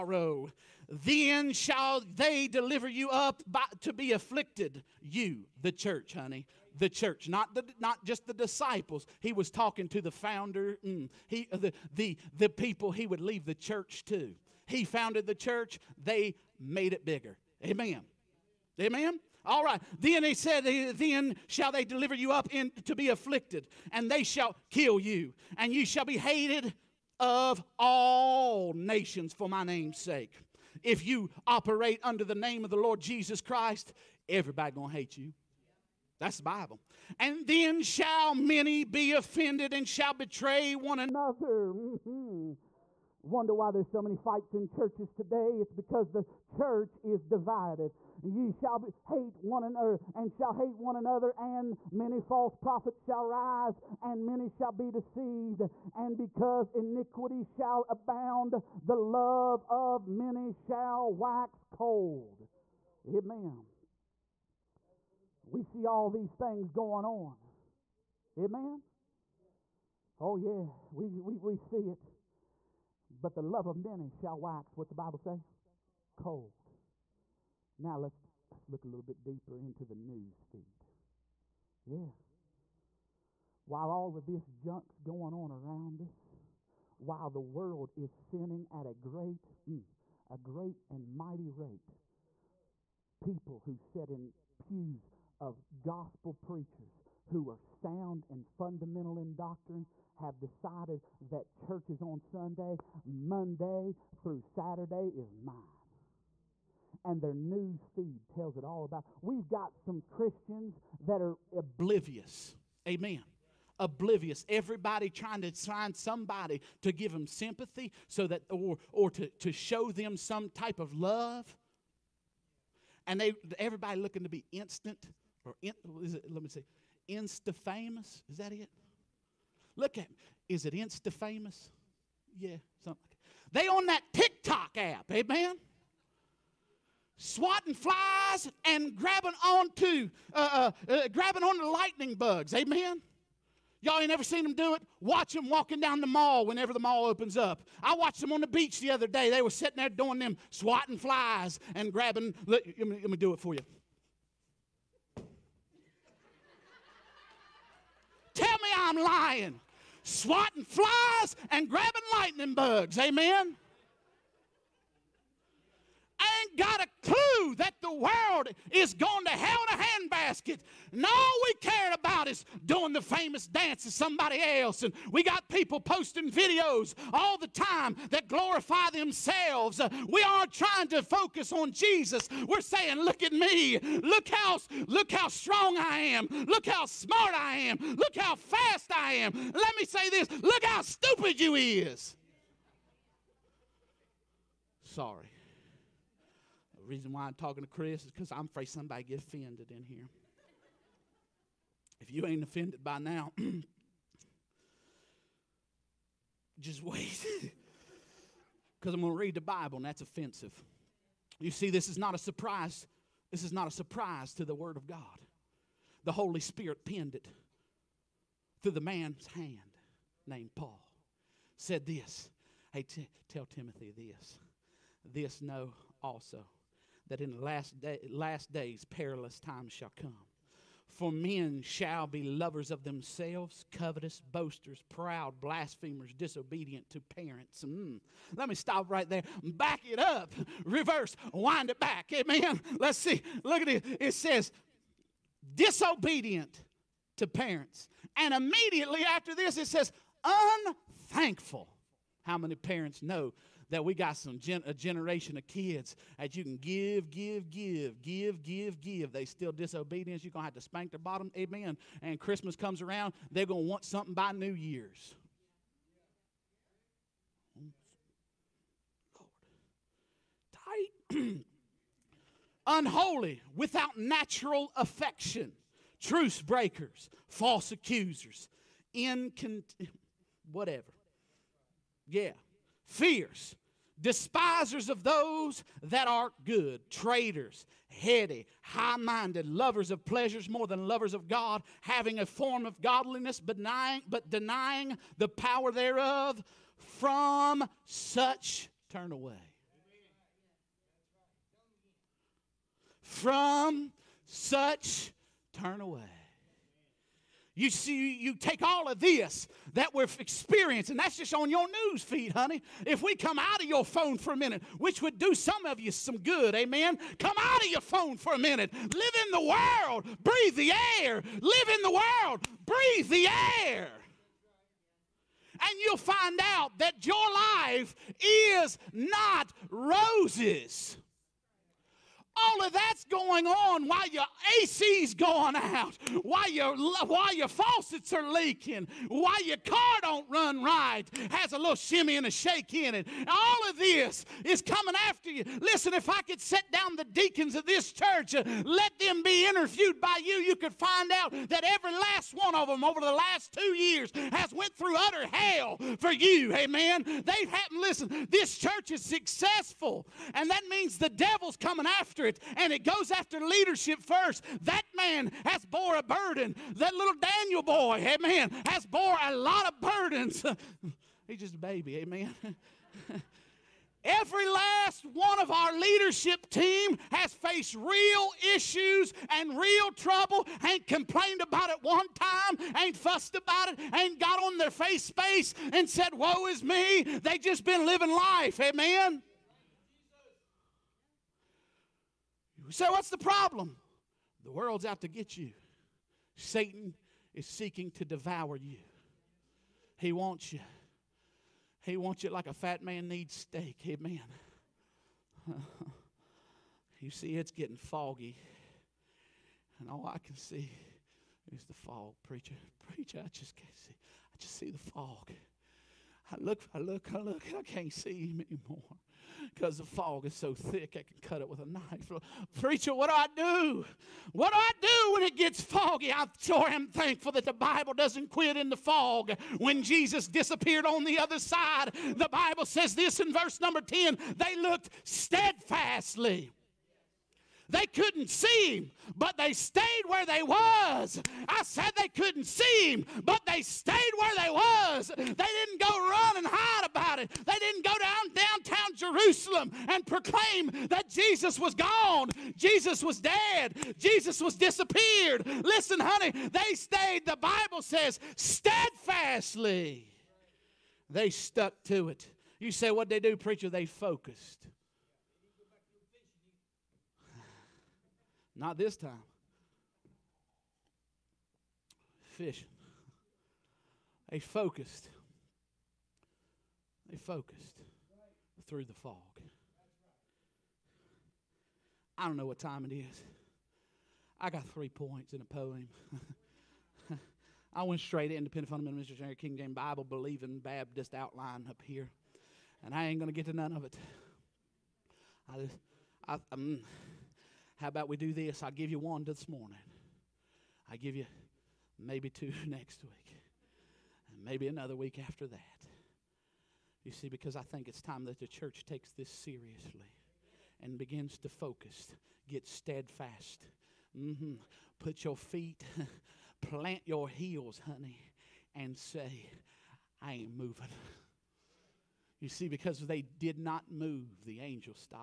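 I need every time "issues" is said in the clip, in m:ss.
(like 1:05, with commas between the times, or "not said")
6:18.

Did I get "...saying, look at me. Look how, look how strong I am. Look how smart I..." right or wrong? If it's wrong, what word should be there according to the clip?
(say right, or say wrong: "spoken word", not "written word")
right.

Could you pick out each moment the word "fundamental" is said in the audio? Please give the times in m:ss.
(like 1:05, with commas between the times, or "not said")
1:38, 8:08.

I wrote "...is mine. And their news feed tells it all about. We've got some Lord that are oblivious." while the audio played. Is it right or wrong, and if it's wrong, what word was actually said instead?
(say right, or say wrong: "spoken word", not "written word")
wrong: "Christians", not "Lord".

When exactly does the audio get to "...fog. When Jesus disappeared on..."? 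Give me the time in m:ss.
7:08.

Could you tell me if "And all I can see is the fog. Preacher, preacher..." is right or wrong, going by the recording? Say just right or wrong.
right.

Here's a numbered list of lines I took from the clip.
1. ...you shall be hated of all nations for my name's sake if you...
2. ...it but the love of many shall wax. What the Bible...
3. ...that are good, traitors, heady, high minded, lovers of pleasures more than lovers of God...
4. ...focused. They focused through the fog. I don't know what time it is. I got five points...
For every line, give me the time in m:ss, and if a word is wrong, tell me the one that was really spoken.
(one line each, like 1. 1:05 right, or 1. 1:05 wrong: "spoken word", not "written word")
1. 0:25 right
2. 1:11 right
3. 4:45 right
4. 7:54 wrong: "three", not "five".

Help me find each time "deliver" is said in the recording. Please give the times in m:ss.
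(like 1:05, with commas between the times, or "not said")
0:02, 0:21.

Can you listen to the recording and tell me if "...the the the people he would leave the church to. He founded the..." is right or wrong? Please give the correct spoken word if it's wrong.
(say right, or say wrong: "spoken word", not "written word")
right.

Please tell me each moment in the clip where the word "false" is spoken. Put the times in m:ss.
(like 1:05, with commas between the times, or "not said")
0:52, 4:37.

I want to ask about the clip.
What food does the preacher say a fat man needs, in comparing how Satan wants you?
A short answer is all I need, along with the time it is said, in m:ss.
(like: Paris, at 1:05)
steak, at 6:43.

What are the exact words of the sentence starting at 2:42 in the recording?
Amen got a clue that the world is going to hell in a handbasket.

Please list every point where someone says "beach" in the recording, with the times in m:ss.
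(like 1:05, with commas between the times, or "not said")
2:28.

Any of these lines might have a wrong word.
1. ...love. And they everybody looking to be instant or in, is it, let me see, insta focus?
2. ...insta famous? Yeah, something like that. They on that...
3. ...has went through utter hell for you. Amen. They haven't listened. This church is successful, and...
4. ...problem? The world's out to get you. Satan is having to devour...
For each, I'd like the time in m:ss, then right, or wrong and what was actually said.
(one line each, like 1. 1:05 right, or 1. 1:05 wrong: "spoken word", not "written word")
1. 2:00 wrong: "famous", not "focus"
2. 2:10 right
3. 5:54 right
4. 6:33 wrong: "seeking", not "having".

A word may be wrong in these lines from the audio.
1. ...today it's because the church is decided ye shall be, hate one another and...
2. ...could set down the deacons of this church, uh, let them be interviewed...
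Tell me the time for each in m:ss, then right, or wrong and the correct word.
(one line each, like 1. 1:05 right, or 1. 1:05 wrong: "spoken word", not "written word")
1. 0:45 wrong: "divided", not "decided"
2. 5:46 right.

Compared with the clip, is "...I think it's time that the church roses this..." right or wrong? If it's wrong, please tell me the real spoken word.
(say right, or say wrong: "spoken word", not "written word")
wrong: "takes", not "roses".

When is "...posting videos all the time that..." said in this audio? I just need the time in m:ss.
2:55.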